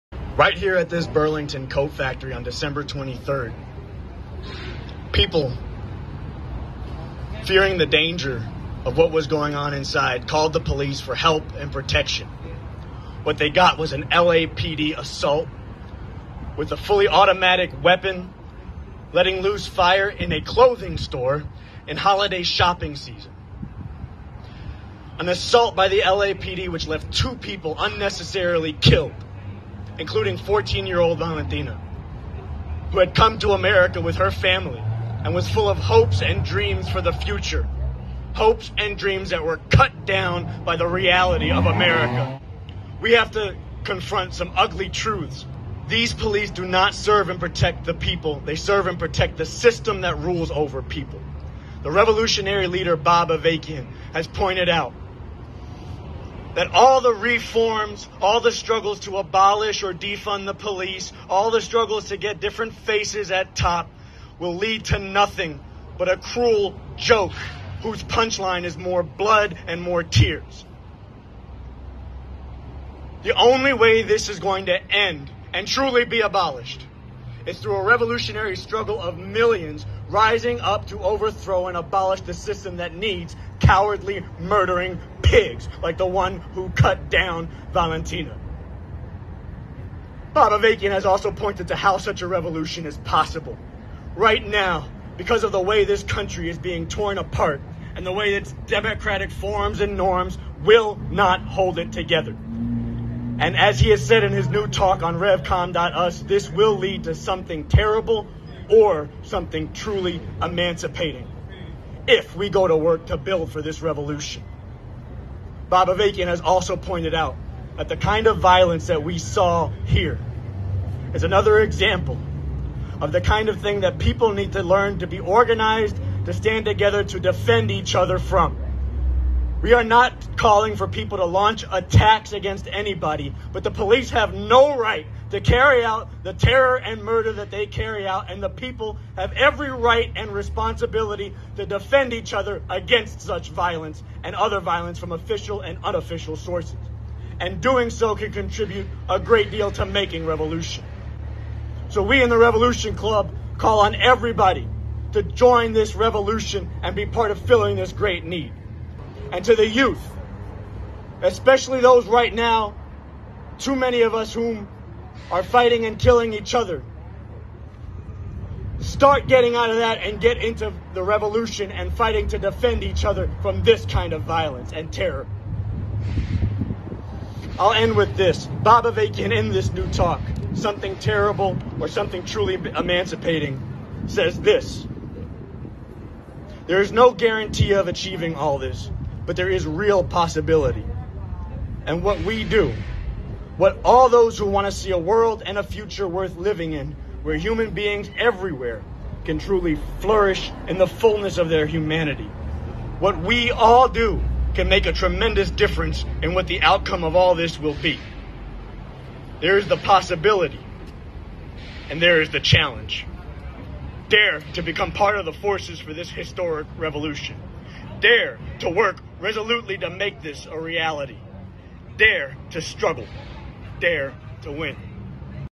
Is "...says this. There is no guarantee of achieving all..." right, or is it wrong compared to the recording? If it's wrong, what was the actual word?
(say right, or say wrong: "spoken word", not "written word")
right.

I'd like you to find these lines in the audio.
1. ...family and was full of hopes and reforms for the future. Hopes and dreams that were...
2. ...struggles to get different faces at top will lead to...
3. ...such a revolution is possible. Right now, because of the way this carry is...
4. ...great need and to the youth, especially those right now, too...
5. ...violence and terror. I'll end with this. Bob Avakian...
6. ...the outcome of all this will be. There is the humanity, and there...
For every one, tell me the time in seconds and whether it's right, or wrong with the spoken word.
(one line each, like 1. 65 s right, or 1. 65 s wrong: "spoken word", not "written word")
1. 34 s wrong: "dreams", not "reforms"
2. 61 s right
3. 91 s wrong: "country", not "carry"
4. 157 s right
5. 174 s right
6. 206 s wrong: "possibility", not "humanity".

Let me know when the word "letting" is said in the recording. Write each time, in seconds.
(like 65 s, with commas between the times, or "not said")
19 s.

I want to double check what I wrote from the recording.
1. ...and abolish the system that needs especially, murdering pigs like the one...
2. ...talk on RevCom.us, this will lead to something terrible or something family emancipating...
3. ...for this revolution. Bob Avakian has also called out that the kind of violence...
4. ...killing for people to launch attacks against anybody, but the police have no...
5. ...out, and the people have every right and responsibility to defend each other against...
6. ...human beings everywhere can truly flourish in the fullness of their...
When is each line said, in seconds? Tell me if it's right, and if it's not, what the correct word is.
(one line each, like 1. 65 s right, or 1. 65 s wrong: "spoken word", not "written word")
1. 81 s wrong: "cowardly", not "especially"
2. 104 s wrong: "truly", not "family"
3. 113 s wrong: "pointed", not "called"
4. 130 s wrong: "calling", not "killing"
5. 138 s right
6. 197 s right.